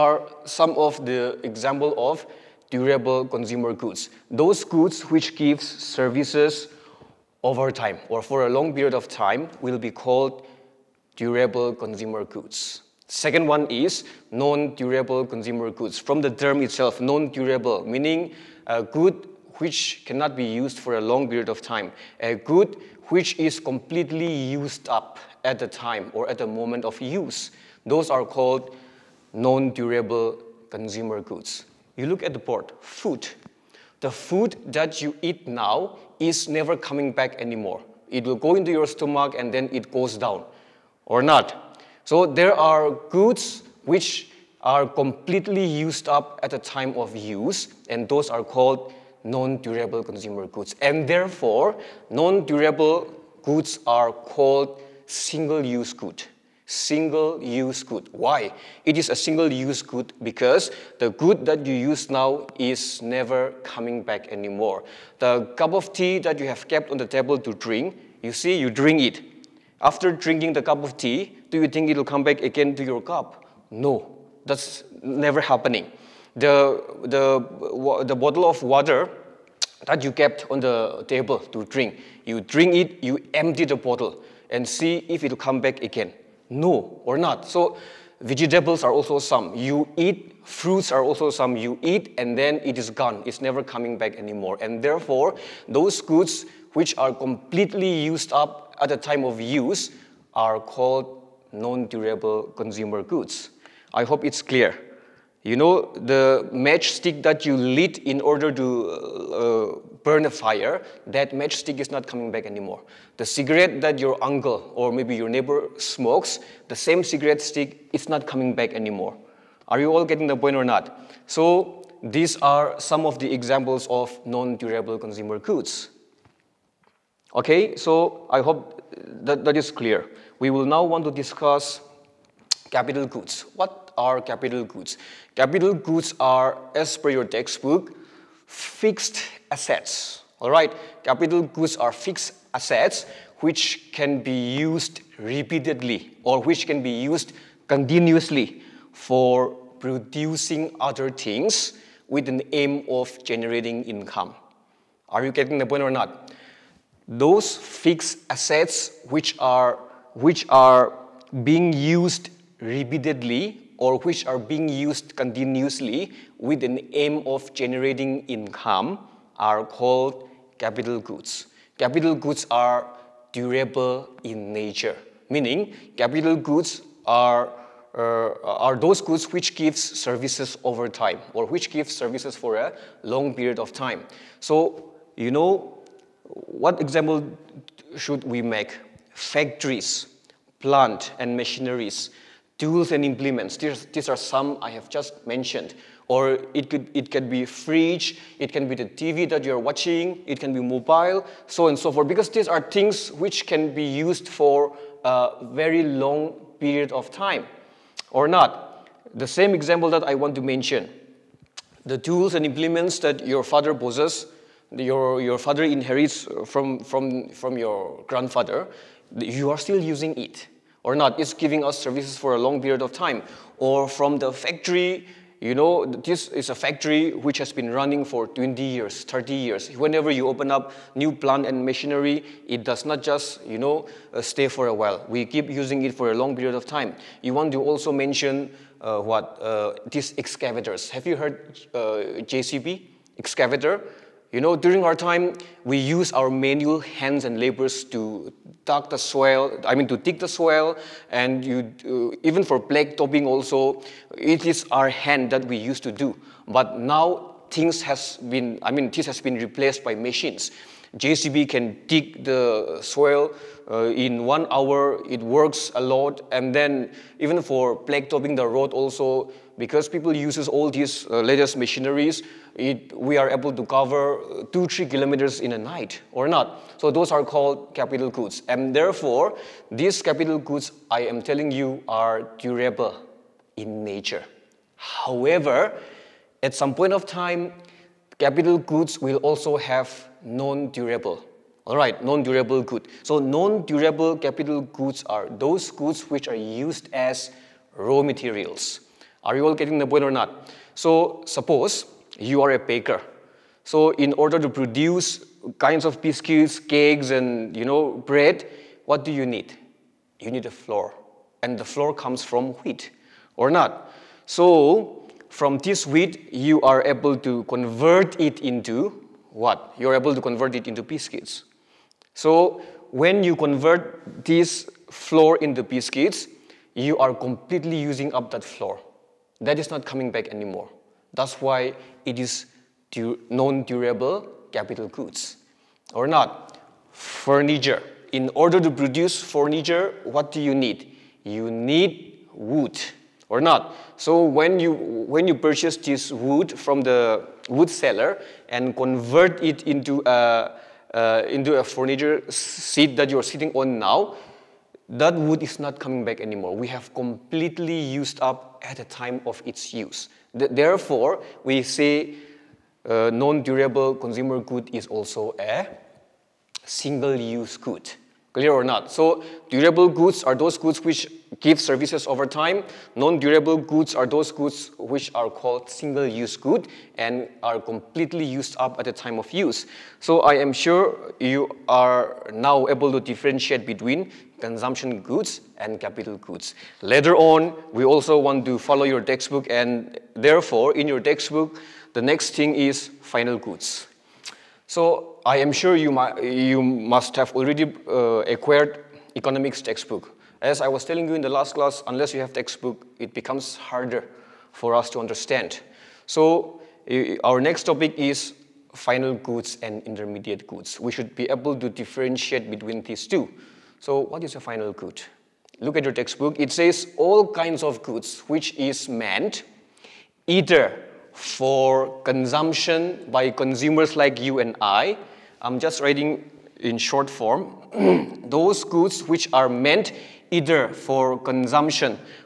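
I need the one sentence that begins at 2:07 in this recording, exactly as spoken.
Okay, so I hope that, that is clear.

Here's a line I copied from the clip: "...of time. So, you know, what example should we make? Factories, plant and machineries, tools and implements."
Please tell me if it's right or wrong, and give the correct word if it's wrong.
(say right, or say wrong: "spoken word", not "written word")
right.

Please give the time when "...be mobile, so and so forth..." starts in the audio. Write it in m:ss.
3:20.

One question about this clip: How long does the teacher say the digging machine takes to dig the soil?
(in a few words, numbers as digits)
One hour.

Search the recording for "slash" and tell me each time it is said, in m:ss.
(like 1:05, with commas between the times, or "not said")
not said.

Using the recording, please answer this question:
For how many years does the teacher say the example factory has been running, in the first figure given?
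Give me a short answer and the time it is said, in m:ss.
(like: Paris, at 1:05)
20 years, at 3:48.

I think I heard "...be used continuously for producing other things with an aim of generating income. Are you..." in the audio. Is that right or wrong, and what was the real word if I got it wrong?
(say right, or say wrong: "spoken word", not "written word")
right.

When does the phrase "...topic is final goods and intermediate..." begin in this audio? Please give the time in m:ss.
6:47.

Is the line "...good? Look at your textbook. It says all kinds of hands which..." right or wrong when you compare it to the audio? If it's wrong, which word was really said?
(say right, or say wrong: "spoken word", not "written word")
wrong: "goods", not "hands".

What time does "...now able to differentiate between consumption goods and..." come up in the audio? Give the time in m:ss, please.
6:22.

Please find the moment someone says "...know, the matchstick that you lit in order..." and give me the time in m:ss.
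1:45.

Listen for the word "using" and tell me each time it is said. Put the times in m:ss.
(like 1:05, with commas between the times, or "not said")
3:39, 3:55, 5:27.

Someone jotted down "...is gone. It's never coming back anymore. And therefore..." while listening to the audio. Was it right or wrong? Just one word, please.
right.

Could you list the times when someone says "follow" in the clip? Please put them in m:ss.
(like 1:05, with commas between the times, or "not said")
6:28.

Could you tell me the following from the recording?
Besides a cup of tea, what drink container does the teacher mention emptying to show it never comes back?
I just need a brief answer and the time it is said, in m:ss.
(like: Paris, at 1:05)
Bottle of water, at 1:18.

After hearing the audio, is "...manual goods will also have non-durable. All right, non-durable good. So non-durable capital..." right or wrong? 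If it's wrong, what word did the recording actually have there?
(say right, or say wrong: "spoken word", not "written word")
wrong: "capital", not "manual".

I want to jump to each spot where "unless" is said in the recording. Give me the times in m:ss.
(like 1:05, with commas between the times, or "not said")
6:41.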